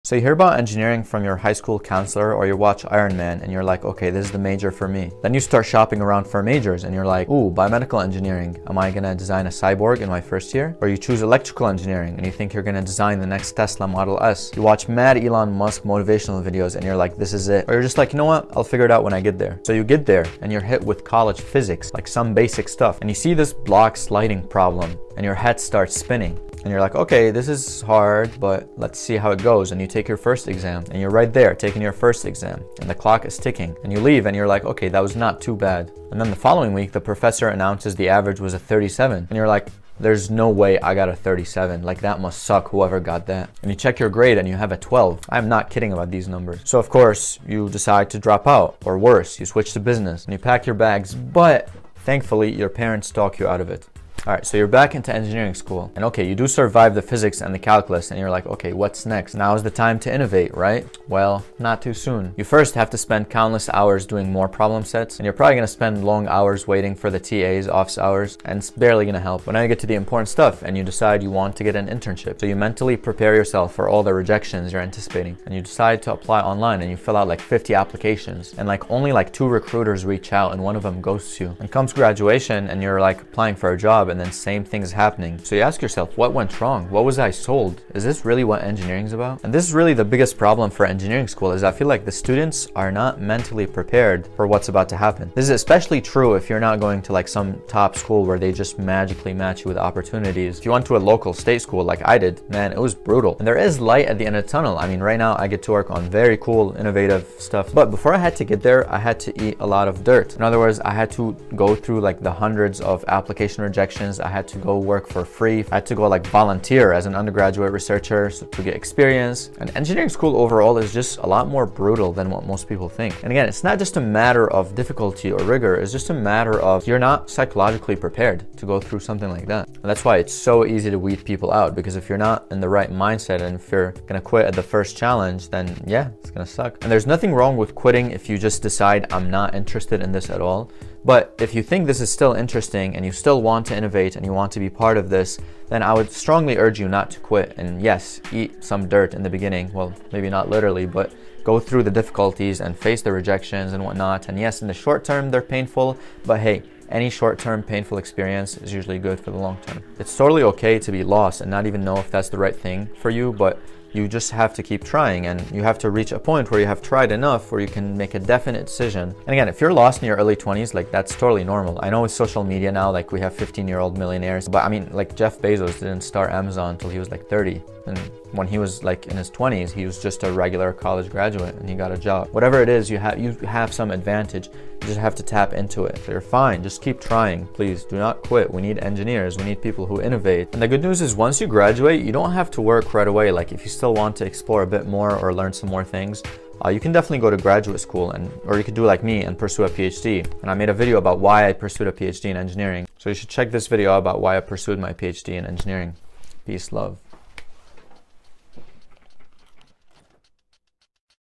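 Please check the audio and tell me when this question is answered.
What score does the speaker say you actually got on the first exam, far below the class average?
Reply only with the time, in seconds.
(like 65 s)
44 s.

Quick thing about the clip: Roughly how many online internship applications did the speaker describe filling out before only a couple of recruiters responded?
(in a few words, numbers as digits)
50.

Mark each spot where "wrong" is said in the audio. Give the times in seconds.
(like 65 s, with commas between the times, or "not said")
86 s, 137 s.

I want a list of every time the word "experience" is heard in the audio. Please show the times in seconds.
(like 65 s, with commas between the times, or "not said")
118 s, 157 s.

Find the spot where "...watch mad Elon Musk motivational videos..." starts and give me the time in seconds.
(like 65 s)
14 s.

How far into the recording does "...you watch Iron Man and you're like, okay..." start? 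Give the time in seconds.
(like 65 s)
2 s.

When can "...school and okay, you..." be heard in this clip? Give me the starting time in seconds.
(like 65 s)
55 s.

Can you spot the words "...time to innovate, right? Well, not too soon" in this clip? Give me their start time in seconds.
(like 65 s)
59 s.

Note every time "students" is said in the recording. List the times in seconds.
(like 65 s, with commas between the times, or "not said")
92 s.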